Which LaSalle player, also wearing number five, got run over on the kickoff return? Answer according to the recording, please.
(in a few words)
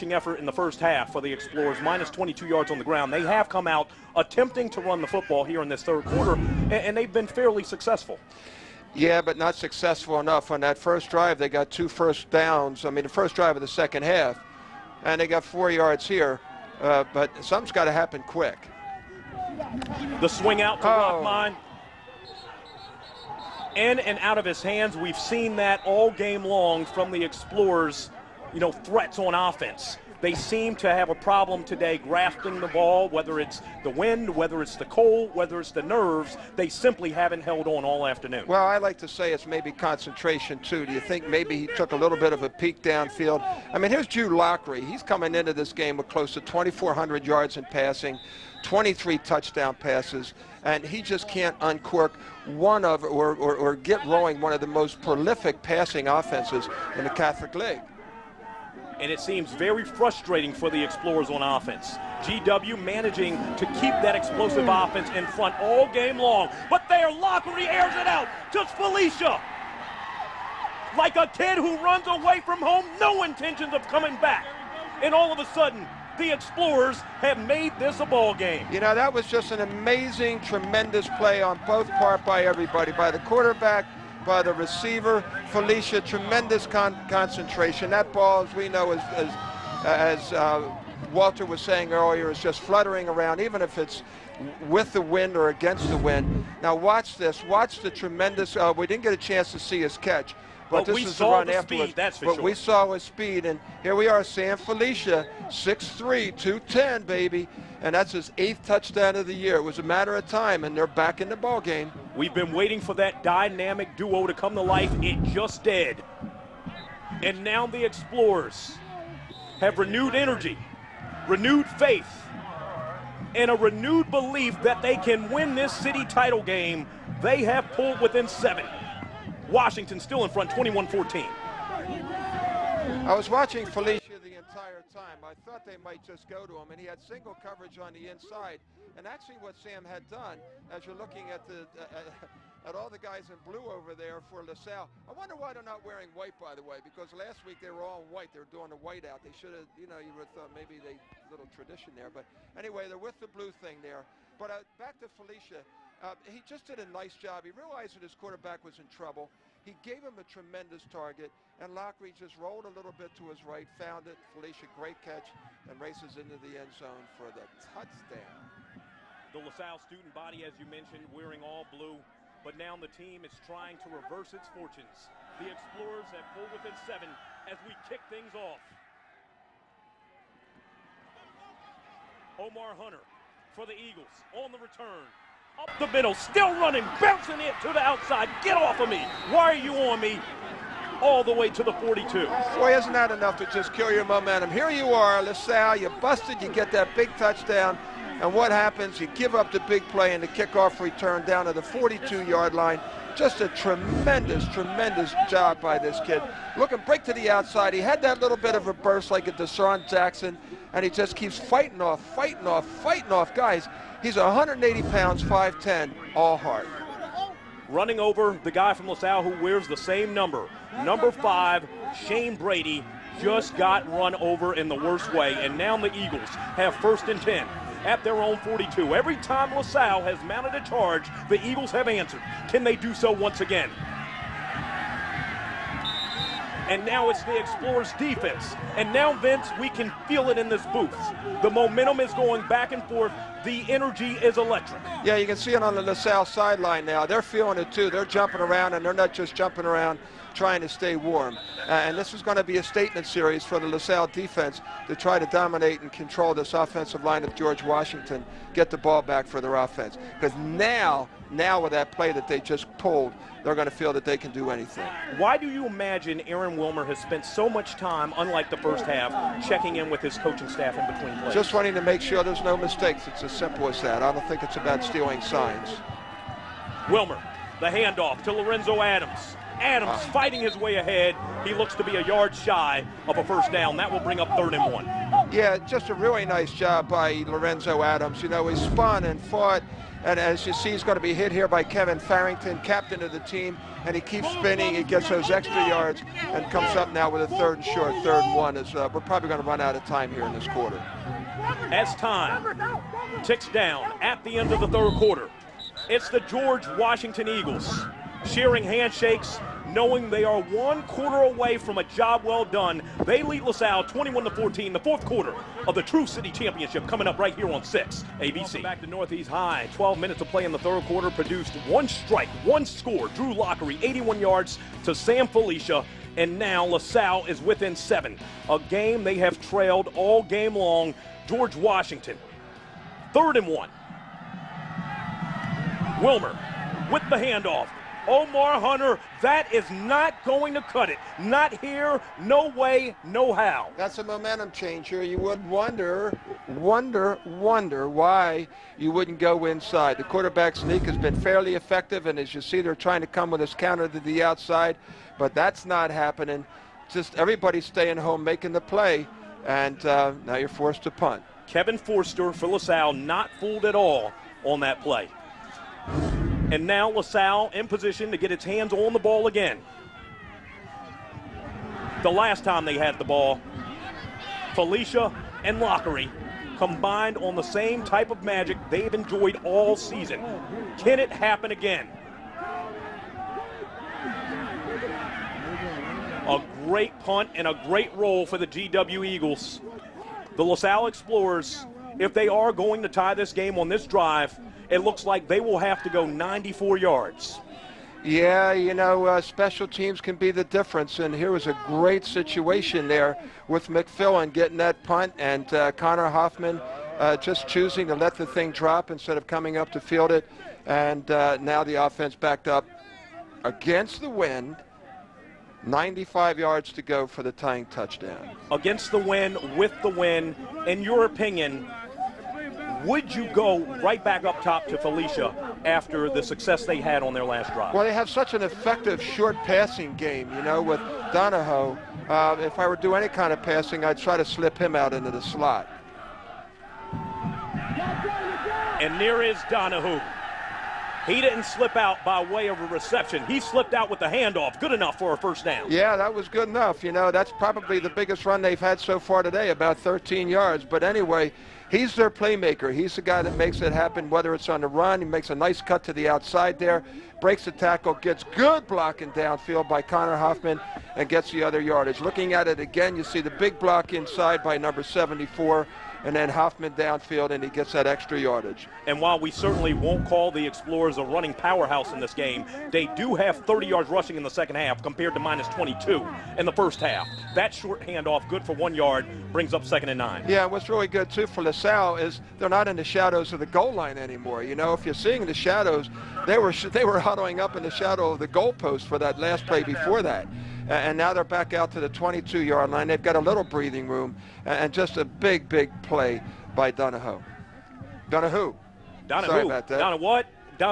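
Shane Brady.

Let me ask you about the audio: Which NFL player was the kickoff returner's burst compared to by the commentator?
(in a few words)
DeSean Jackson.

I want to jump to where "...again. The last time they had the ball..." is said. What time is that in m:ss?
6:09.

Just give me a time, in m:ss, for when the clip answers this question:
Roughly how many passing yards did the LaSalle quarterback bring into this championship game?
0:46.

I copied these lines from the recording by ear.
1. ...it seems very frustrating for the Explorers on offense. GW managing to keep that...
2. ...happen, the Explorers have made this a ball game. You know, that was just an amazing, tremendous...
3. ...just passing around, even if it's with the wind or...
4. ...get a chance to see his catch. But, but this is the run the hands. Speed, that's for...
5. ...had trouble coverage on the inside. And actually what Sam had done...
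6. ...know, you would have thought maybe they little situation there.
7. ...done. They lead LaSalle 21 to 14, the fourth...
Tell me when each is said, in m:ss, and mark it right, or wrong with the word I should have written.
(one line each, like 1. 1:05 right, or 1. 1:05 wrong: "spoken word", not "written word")
1. 0:59 right
2. 1:15 wrong: "sudden", not "happen"
3. 1:32 wrong: "fluttering", not "passing"
4. 1:39 wrong: "afterwards", not "hands"
5. 2:16 wrong: "single", not "trouble"
6. 2:29 wrong: "tradition", not "situation"
7. 5:12 right.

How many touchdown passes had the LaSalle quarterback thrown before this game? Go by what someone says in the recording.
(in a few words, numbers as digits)
23.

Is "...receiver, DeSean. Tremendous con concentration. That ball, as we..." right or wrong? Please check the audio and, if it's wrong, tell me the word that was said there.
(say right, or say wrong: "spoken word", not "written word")
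wrong: "Felicia", not "DeSean".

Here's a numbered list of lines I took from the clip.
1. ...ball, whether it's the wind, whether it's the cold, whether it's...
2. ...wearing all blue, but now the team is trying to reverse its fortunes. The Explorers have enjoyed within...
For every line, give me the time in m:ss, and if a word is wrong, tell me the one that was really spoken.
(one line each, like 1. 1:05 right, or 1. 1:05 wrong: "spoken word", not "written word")
1. 0:32 right
2. 2:51 wrong: "pulled", not "enjoyed".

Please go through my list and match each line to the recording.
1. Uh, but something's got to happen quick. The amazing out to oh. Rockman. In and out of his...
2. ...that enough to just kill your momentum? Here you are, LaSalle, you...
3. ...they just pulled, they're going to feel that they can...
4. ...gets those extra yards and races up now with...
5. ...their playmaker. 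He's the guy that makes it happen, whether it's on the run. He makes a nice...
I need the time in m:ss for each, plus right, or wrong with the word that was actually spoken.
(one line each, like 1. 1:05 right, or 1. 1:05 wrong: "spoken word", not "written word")
1. 0:16 wrong: "swing", not "amazing"
2. 3:12 right
3. 4:22 right
4. 4:54 wrong: "comes", not "races"
5. 7:31 right.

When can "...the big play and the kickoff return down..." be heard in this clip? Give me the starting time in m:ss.
3:19.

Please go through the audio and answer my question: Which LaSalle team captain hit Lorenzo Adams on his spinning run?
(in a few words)
Kevin Farrington.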